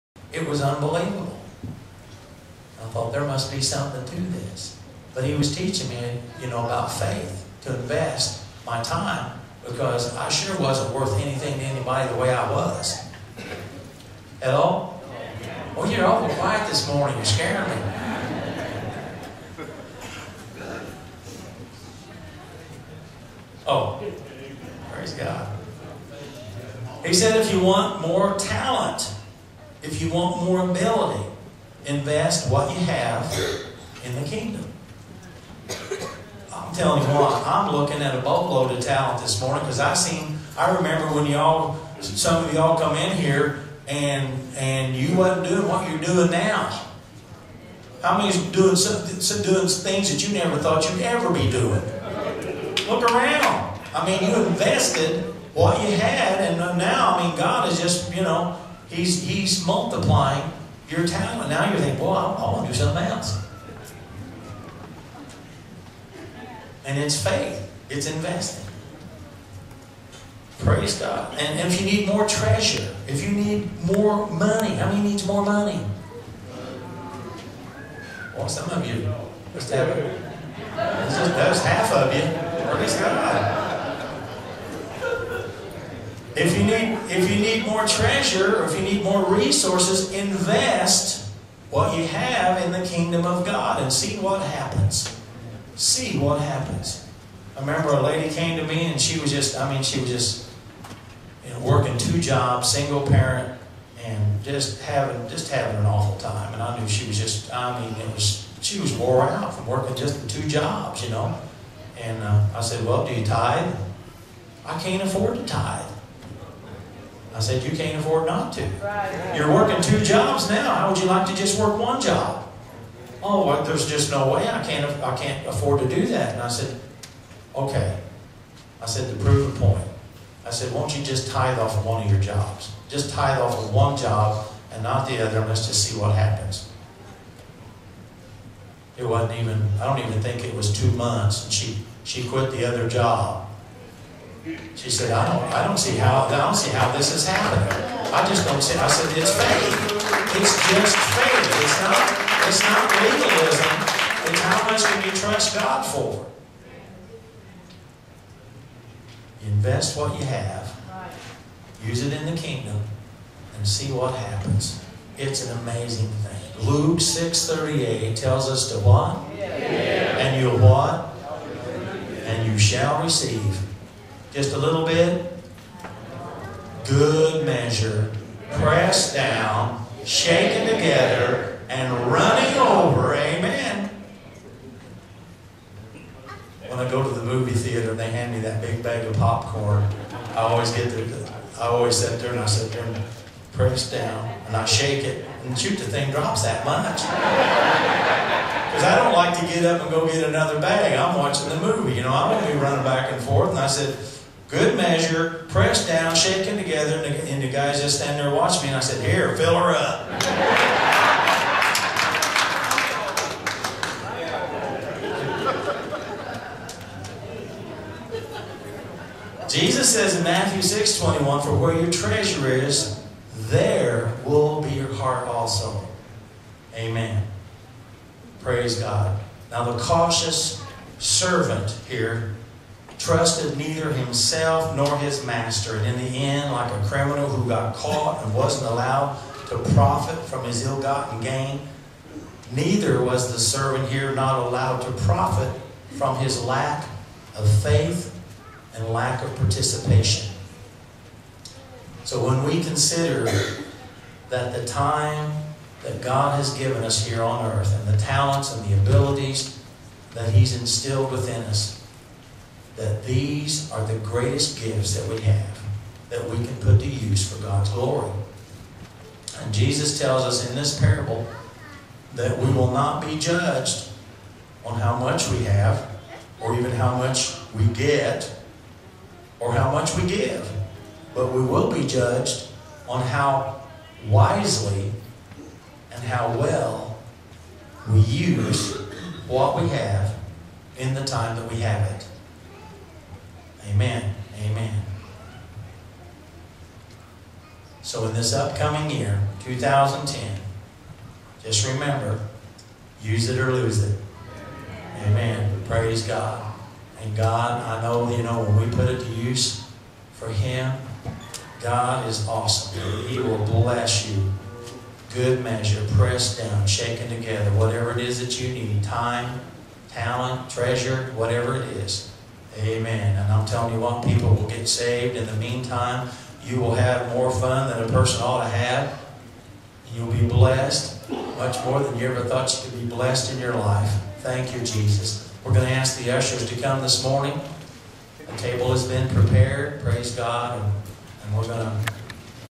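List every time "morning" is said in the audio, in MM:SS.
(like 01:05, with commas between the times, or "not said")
00:16, 00:39, 05:37.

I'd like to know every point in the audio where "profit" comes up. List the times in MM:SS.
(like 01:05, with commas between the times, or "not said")
03:59, 04:05.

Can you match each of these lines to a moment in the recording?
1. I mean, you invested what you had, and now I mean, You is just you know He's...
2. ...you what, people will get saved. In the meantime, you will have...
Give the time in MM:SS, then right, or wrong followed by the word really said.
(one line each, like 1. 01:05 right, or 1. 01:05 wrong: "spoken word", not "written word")
1. 00:53 wrong: "God", not "You"
2. 05:23 right.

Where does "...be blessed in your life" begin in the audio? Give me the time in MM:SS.
05:32.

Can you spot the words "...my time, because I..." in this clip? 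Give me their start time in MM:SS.
00:08.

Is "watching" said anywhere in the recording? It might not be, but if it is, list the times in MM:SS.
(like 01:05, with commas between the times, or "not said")
03:21, 03:28.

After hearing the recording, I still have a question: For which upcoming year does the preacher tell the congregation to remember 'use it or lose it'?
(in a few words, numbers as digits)
2010.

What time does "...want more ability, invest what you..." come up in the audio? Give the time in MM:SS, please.
00:30.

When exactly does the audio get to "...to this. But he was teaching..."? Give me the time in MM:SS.
00:04.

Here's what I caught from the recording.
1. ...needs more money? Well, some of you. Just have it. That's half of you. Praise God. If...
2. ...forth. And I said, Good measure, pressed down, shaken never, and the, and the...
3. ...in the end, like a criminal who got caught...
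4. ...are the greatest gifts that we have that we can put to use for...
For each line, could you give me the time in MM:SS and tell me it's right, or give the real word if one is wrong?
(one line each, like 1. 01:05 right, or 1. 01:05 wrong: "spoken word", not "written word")
1. 01:15 right
2. 03:23 wrong: "together", not "never"
3. 03:55 right
4. 04:23 right.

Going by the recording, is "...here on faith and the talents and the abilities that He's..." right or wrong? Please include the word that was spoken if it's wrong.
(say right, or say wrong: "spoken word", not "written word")
wrong: "earth", not "faith".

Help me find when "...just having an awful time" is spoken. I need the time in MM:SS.
01:45.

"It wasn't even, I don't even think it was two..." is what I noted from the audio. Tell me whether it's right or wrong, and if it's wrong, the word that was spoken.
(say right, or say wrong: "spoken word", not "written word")
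right.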